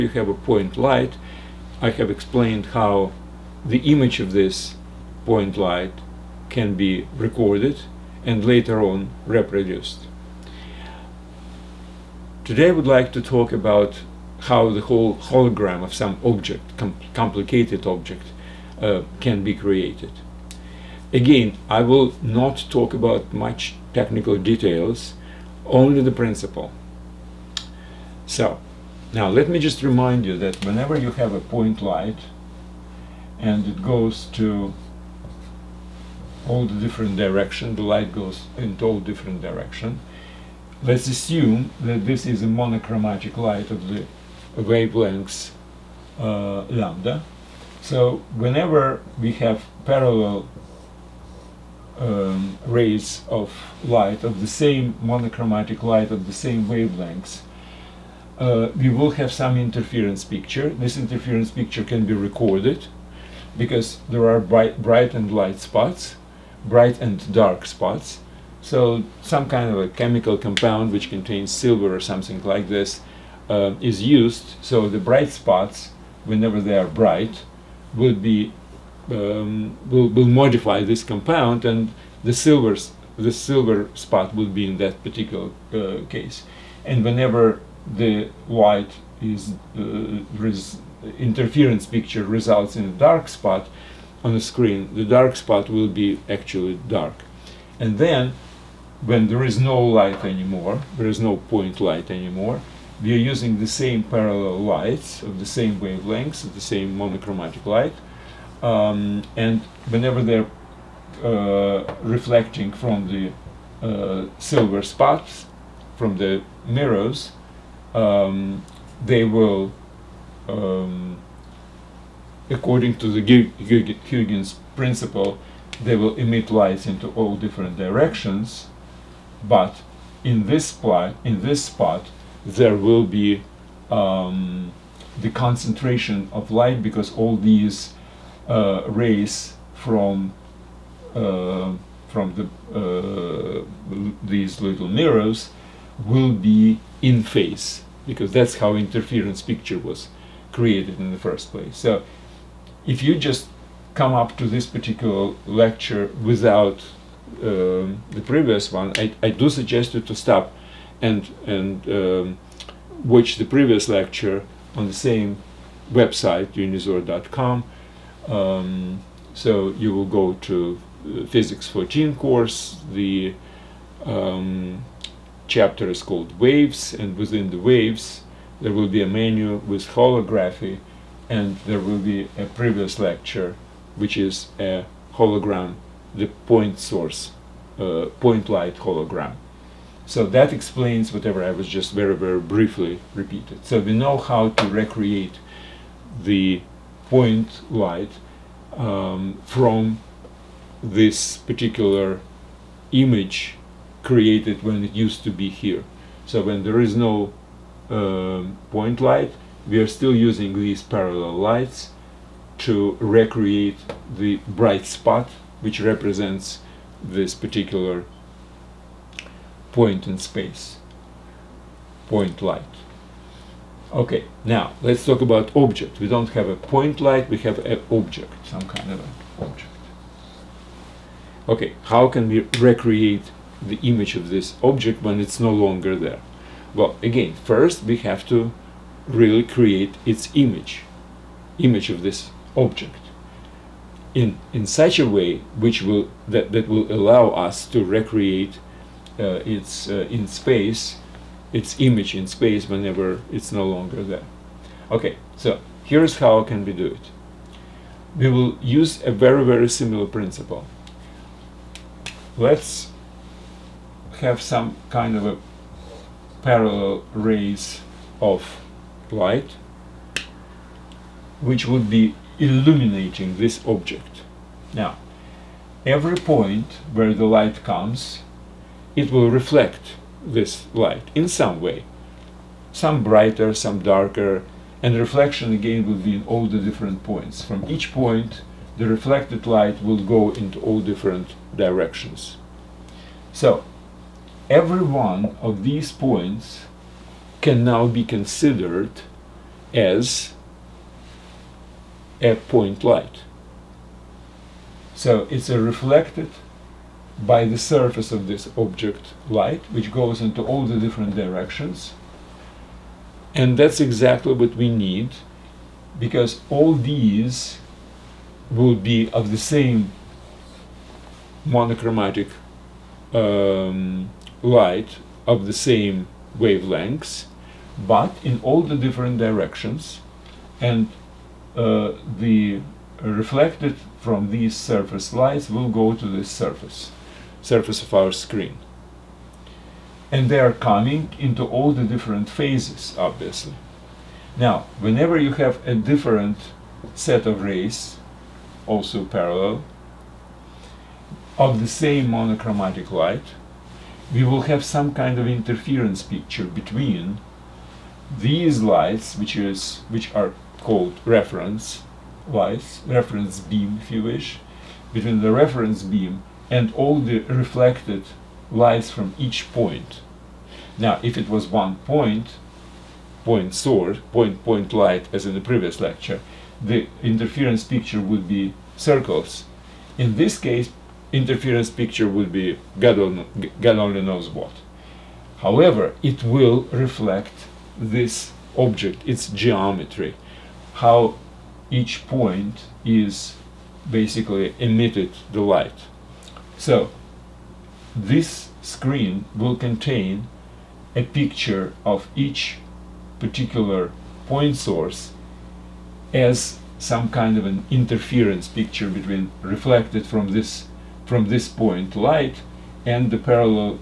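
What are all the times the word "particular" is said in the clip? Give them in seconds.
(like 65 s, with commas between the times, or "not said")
85 s, 154 s, 201 s, 217 s, 403 s.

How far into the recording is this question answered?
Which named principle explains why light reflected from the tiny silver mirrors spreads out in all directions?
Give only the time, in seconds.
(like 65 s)
123 s.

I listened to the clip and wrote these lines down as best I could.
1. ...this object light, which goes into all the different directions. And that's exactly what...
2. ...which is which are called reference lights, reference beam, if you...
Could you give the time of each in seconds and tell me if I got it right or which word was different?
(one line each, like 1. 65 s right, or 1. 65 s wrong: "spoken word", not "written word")
1. 308 s right
2. 359 s right.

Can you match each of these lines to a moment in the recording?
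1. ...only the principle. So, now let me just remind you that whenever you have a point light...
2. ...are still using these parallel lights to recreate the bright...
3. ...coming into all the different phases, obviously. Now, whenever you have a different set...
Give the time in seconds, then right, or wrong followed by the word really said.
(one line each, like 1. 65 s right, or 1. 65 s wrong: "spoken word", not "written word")
1. 25 s right
2. 209 s right
3. 340 s right.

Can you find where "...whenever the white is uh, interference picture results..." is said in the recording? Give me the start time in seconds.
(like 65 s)
87 s.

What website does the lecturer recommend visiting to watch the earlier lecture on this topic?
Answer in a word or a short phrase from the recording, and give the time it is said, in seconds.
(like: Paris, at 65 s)
unizor.com, at 166 s.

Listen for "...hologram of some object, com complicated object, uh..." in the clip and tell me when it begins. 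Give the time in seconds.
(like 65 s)
15 s.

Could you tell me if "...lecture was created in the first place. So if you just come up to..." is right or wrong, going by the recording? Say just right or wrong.
wrong.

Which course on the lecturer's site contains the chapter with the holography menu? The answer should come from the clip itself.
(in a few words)
Physics4Teens.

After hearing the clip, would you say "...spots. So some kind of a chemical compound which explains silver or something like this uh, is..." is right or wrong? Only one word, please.
wrong.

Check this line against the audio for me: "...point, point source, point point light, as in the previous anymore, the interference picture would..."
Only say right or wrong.
wrong.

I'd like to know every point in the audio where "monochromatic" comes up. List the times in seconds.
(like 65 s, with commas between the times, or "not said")
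42 s, 55 s, 106 s, 321 s, 352 s.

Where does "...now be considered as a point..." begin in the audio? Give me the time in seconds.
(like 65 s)
297 s.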